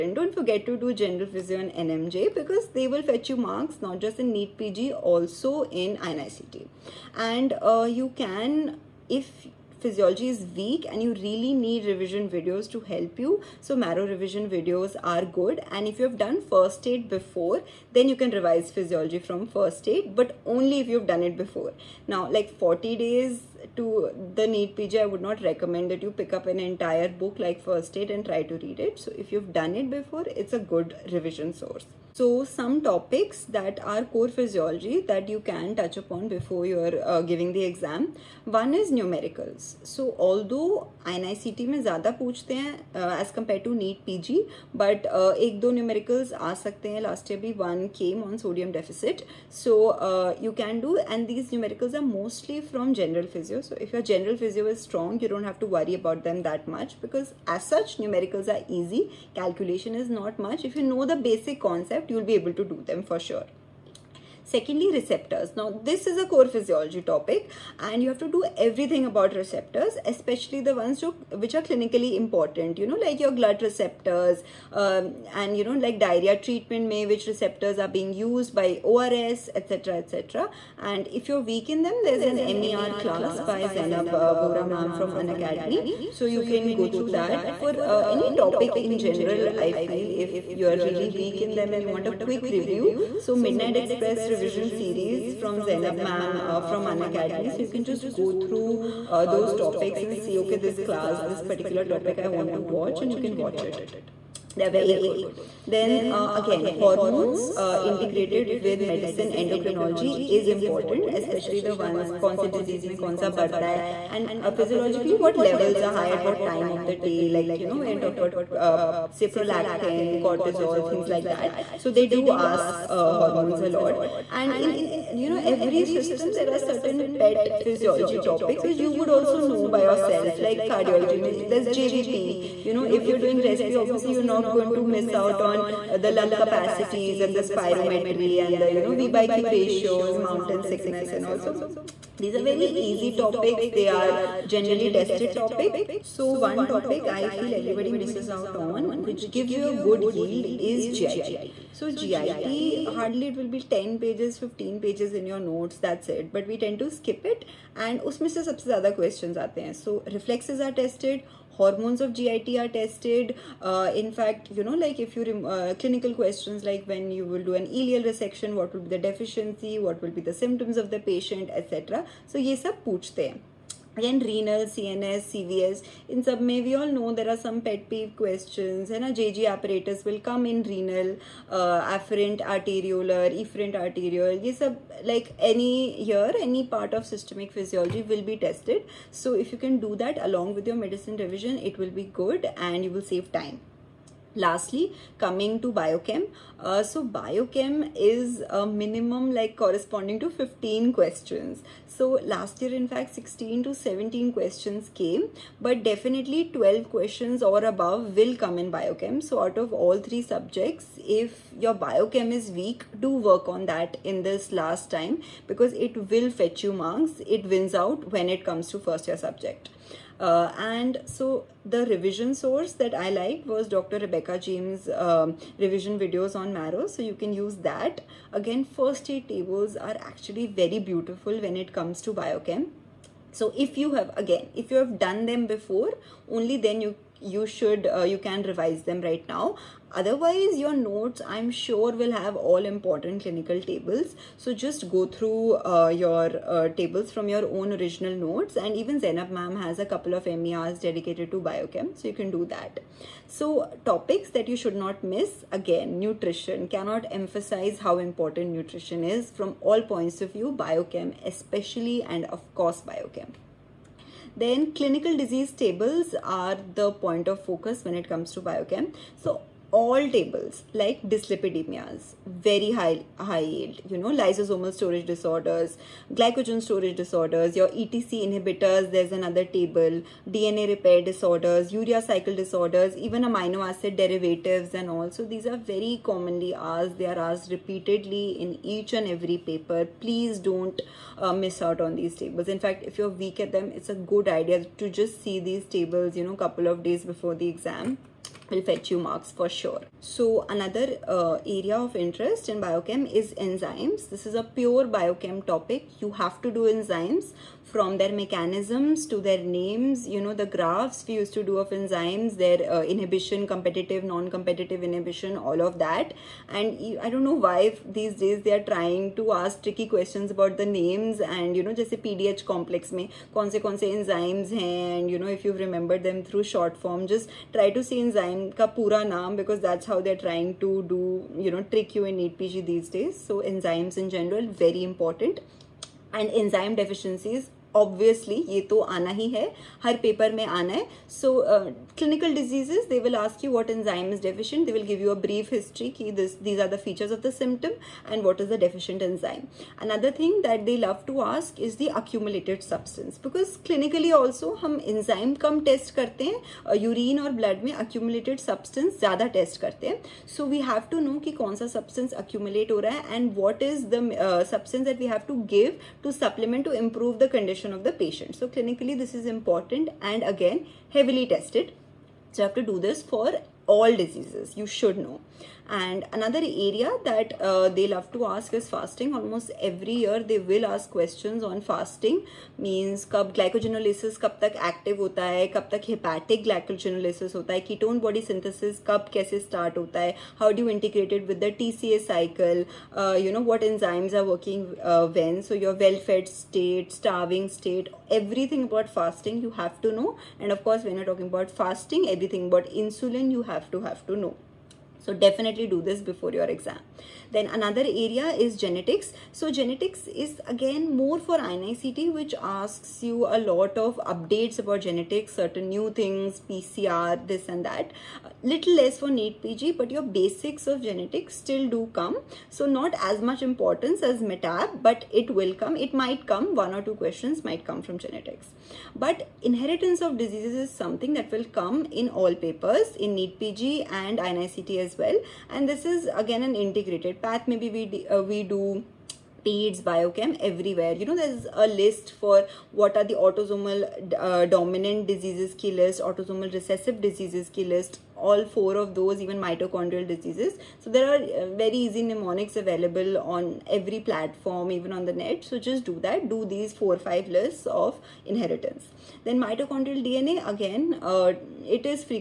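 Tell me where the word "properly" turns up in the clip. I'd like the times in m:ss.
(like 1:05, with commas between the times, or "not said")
not said.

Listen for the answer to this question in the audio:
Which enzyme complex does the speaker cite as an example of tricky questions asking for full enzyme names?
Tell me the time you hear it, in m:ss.
5:21.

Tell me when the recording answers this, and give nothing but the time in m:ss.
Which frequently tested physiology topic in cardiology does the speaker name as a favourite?
2:11.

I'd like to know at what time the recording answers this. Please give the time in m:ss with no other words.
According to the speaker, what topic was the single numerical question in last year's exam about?
0:48.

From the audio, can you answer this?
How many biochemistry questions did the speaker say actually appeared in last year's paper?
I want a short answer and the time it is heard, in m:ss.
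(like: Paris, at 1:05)
16 to 17, at 3:23.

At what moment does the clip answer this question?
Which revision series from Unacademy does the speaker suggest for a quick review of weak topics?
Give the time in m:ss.
1:33.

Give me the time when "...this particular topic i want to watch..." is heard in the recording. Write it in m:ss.
1:41.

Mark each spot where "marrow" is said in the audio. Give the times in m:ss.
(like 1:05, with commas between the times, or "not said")
0:13, 3:46.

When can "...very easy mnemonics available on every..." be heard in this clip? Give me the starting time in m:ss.
7:31.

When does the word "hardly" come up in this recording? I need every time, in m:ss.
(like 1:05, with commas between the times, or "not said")
2:32.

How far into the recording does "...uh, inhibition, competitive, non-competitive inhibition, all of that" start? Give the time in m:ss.
5:12.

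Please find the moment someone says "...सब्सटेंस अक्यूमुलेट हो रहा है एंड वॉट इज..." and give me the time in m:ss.
6:01.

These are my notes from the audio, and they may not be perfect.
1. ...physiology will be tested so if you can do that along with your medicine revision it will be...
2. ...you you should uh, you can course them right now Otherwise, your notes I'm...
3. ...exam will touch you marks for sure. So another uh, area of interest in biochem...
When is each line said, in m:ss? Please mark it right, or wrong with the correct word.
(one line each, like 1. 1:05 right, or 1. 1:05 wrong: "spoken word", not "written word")
1. 3:07 right
2. 3:56 wrong: "revise", not "course"
3. 4:57 wrong: "fetch", not "touch".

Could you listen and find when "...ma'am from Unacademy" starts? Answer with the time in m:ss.
1:24.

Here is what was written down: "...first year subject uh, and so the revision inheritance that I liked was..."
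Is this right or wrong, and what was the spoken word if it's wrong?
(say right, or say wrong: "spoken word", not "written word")
wrong: "source", not "inheritance".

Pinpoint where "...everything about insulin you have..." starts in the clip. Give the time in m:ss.
6:42.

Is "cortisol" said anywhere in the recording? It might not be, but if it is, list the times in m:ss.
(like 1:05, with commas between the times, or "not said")
2:00.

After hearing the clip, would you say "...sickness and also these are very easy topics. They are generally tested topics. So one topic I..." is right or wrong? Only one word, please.
right.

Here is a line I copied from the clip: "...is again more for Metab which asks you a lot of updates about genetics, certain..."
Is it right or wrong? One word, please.
wrong.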